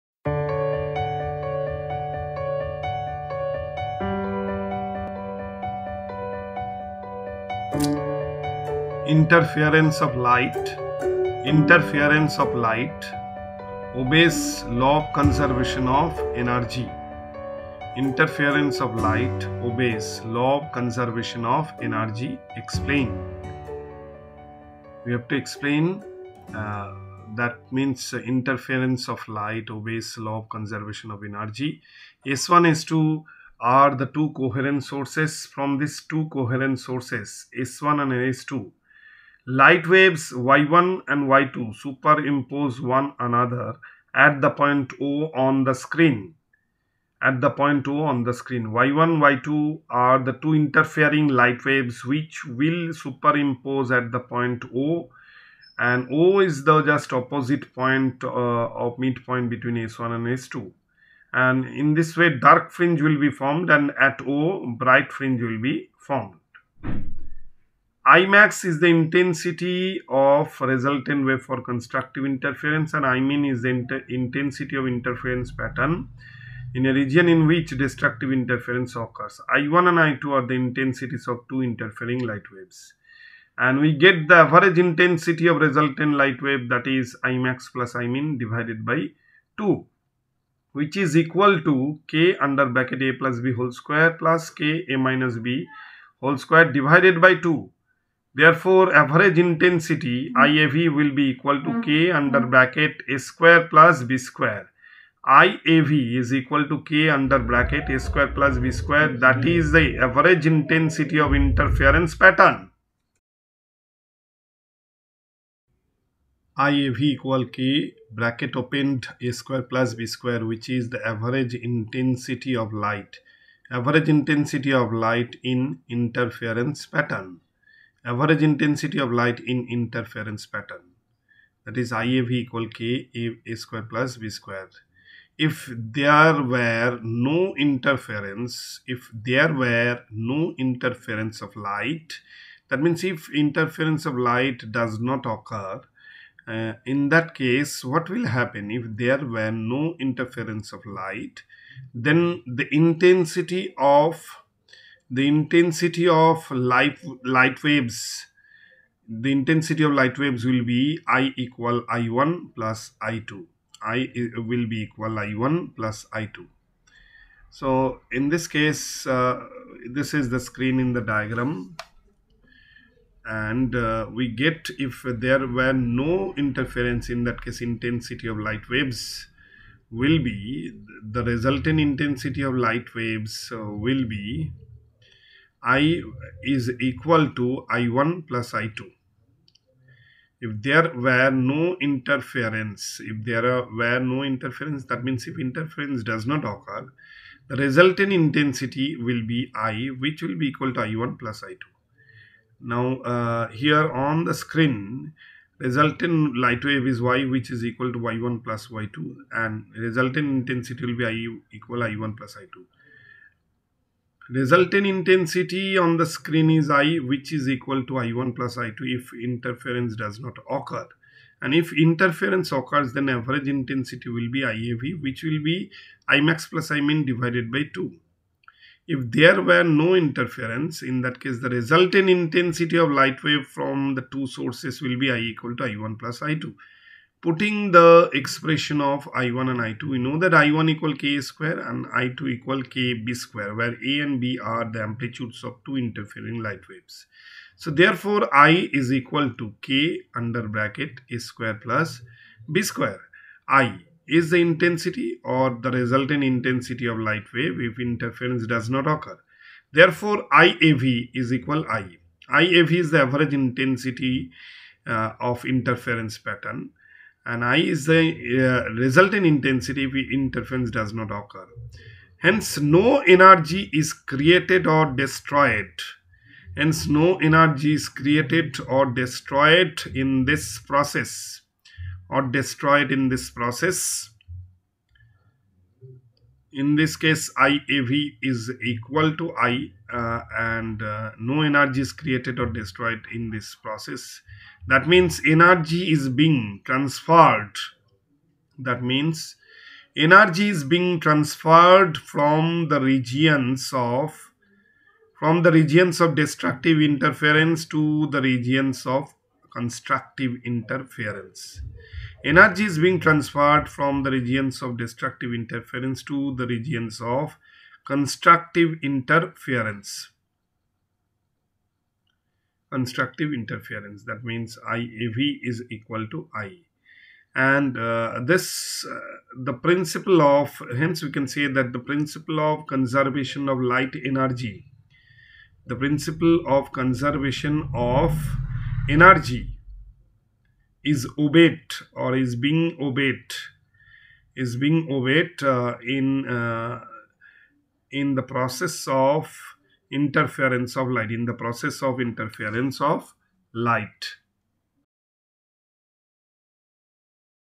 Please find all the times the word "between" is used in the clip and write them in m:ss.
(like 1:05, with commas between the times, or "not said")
0:59.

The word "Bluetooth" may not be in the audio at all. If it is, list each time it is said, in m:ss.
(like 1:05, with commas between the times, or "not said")
not said.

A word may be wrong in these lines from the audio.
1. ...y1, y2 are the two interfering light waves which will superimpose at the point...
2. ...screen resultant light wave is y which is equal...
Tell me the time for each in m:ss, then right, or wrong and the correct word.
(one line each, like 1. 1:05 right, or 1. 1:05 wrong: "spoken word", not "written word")
1. 0:48 right
2. 3:24 right.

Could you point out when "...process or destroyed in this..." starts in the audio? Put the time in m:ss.
4:40.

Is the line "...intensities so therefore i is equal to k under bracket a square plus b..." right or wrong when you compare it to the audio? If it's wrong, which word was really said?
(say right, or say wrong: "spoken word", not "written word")
wrong: "waves", not "intensities".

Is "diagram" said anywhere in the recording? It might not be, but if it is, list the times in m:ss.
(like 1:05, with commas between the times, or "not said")
2:51.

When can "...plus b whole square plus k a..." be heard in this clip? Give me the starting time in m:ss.
1:33.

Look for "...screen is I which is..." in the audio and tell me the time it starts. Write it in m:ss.
3:36.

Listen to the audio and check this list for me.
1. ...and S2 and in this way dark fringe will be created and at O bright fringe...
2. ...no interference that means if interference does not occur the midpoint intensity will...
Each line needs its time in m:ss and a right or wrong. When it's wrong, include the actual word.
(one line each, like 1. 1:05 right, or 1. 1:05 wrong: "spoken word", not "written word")
1. 1:00 wrong: "formed", not "created"
2. 3:13 wrong: "resultant", not "midpoint".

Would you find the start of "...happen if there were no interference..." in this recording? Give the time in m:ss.
2:28.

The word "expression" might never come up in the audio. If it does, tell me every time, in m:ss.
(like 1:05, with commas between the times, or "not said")
3:58.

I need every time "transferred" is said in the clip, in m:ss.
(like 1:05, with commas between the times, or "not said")
4:56, 5:00, 5:12.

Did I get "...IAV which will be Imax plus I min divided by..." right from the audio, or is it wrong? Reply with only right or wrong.
right.